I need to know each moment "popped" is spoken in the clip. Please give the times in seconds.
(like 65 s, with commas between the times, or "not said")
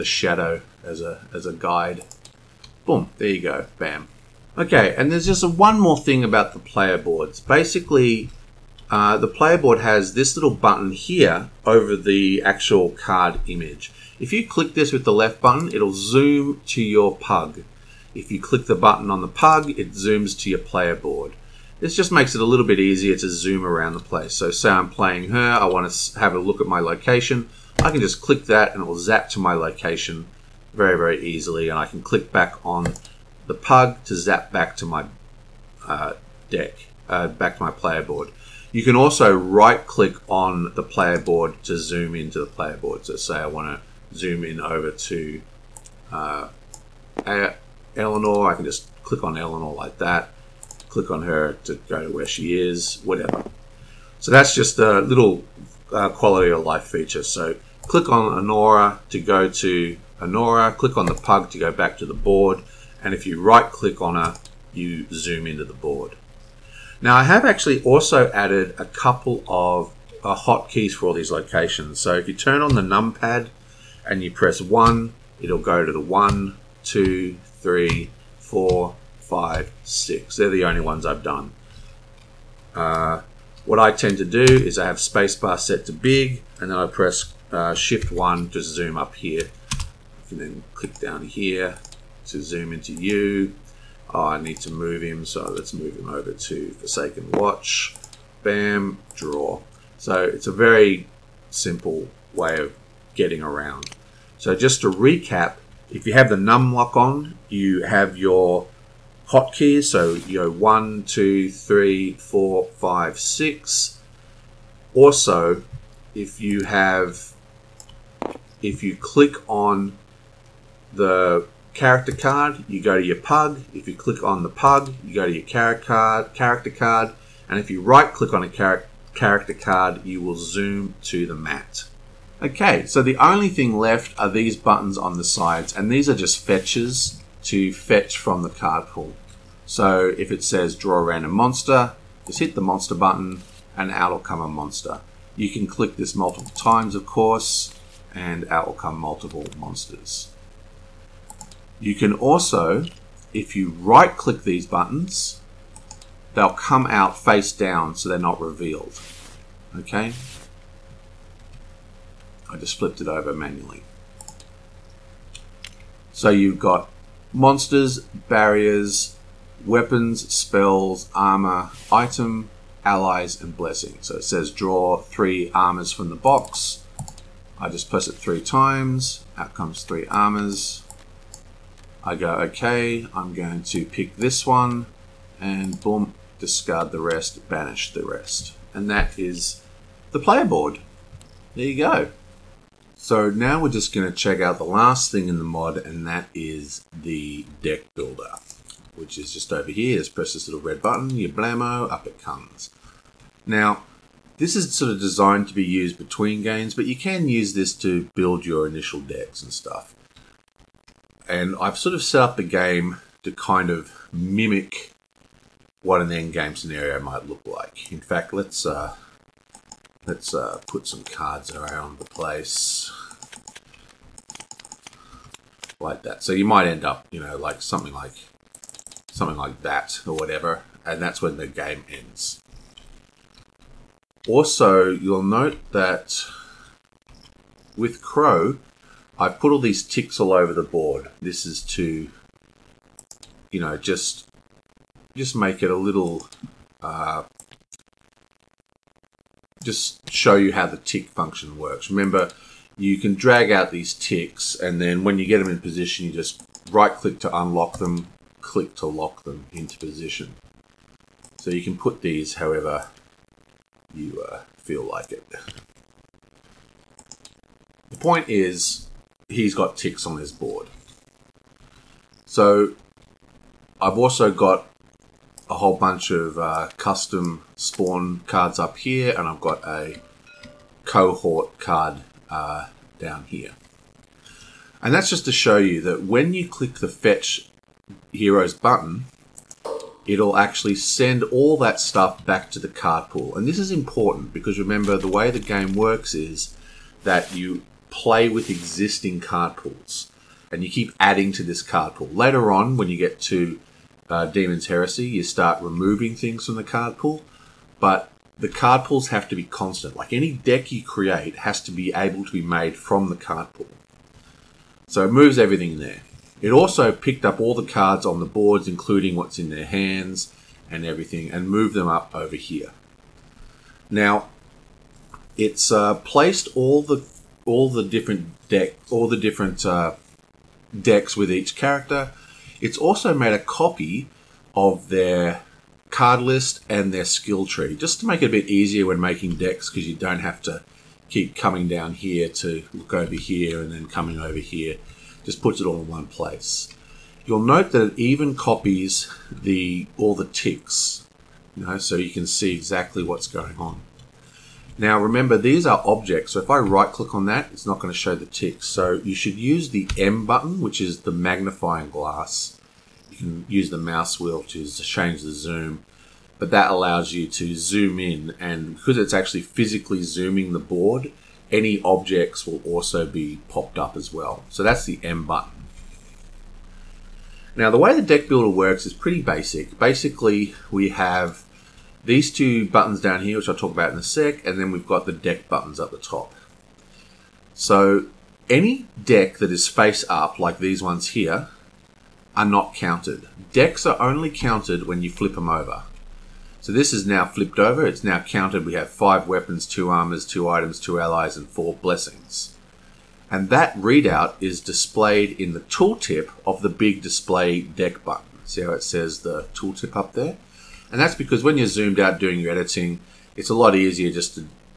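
373 s.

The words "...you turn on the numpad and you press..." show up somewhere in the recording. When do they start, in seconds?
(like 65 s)
72 s.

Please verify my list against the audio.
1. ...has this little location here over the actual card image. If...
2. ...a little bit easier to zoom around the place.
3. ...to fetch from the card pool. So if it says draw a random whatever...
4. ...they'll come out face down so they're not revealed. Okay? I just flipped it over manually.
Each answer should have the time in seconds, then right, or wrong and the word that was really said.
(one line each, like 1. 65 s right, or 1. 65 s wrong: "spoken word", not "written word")
1. 9 s wrong: "button", not "location"
2. 22 s right
3. 137 s wrong: "monster", not "whatever"
4. 156 s right.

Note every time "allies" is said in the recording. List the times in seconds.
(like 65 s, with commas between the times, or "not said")
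172 s, 400 s.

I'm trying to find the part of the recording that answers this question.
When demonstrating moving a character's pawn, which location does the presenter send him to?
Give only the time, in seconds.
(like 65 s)
96 s.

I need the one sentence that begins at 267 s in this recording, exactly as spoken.
The point is, he's got ticks on his board.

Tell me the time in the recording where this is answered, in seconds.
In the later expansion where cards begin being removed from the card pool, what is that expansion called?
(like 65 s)
304 s.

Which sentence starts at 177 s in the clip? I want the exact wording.
I just press it three times.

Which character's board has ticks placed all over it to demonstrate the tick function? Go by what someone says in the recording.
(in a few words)
Crowe.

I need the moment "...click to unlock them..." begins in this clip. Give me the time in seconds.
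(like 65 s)
256 s.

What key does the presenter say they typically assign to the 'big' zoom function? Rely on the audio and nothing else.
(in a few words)
Spacebar.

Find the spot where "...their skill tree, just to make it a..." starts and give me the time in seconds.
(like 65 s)
336 s.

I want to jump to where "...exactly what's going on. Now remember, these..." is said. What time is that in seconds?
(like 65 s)
352 s.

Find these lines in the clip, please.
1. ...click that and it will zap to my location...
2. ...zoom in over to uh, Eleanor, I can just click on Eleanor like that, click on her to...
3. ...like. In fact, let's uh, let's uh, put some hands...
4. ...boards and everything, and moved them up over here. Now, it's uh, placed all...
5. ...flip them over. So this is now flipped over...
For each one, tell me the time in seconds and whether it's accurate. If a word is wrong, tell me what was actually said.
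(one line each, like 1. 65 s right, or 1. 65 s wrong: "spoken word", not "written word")
1. 28 s right
2. 44 s right
3. 217 s wrong: "cards", not "hands"
4. 319 s wrong: "hands", not "boards"
5. 395 s right.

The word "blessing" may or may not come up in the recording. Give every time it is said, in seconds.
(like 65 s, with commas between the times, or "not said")
173 s, 401 s.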